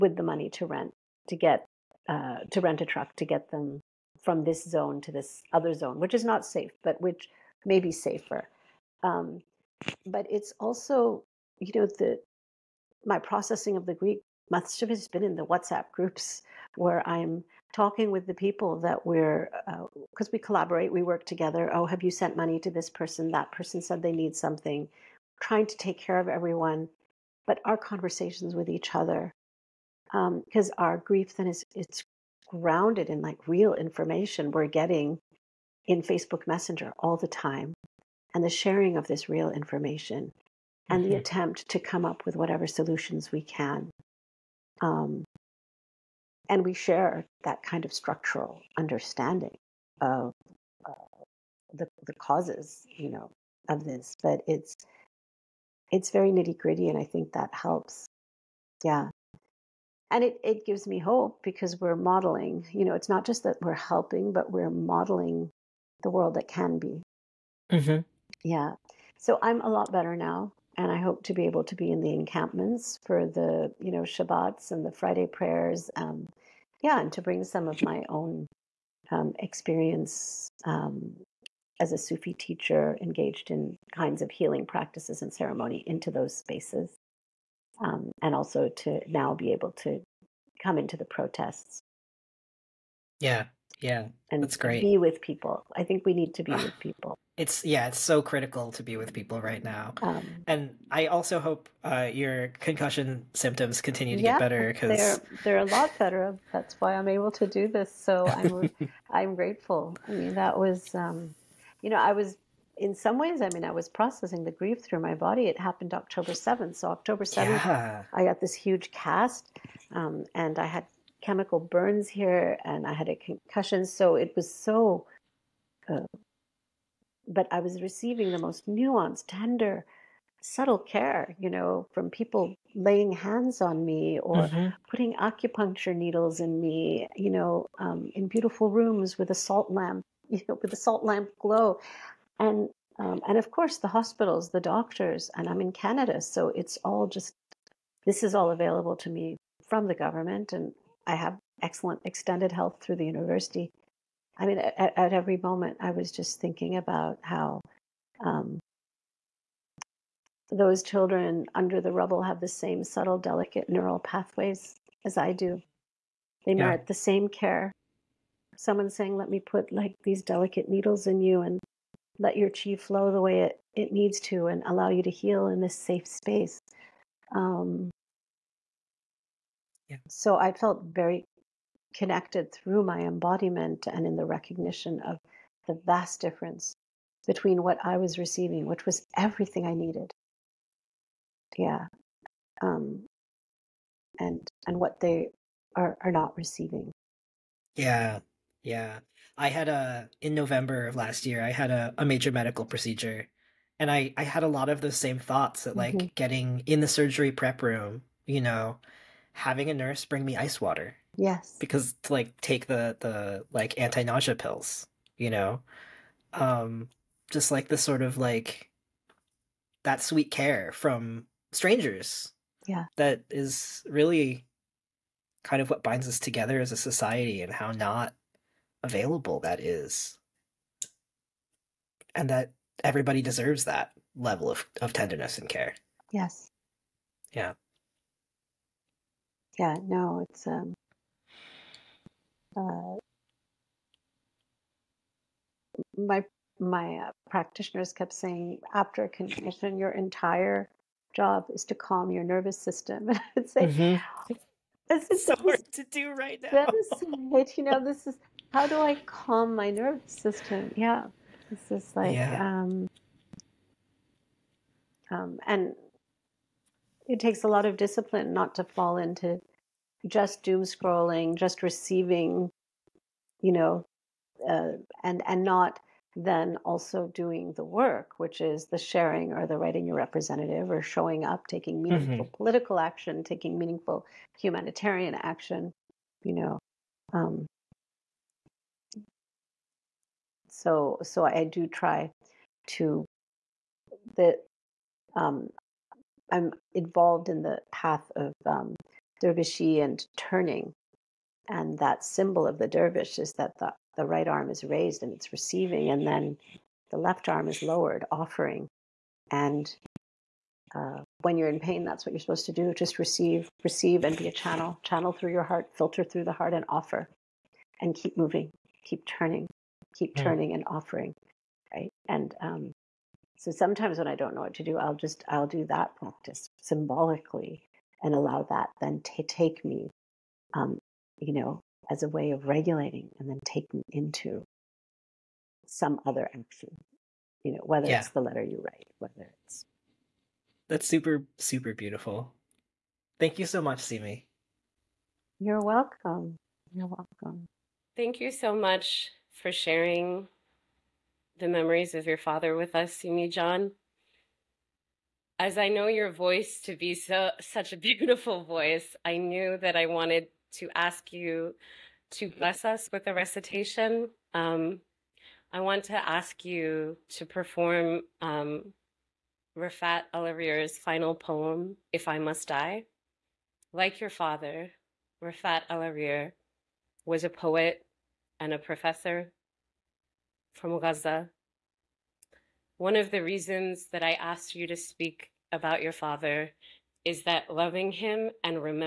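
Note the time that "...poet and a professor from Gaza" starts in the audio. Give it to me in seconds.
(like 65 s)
377 s.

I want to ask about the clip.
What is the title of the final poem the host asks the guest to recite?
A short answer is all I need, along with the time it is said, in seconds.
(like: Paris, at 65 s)
If I Must Die, at 371 s.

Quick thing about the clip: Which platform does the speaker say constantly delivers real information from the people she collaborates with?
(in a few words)
Facebook Messenger.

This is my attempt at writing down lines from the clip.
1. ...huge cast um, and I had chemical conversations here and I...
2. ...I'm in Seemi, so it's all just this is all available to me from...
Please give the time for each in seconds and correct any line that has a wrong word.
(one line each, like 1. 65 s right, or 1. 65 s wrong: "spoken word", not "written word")
1. 118 s wrong: "burns", not "conversations"
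2. 145 s wrong: "Canada", not "Seemi".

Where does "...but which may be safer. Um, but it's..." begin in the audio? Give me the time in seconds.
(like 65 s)
6 s.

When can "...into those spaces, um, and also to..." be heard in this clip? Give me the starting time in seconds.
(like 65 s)
85 s.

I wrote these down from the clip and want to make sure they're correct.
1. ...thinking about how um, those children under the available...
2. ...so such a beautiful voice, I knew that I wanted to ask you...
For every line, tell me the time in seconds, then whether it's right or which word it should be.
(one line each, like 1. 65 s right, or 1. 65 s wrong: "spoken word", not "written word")
1. 156 s wrong: "rubble", not "available"
2. 356 s right.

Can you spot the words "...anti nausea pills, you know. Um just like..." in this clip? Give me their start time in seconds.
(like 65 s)
213 s.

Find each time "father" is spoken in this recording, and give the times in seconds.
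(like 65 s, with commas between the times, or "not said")
352 s, 374 s, 385 s.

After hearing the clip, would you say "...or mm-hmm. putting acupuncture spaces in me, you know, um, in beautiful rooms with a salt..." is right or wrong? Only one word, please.
wrong.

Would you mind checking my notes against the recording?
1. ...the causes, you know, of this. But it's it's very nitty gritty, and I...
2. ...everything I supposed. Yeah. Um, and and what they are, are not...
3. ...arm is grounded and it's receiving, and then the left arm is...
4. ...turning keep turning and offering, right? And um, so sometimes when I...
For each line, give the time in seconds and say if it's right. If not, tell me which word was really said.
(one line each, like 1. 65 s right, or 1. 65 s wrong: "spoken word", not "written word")
1. 52 s right
2. 189 s wrong: "needed", not "supposed"
3. 304 s wrong: "raised", not "grounded"
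4. 319 s right.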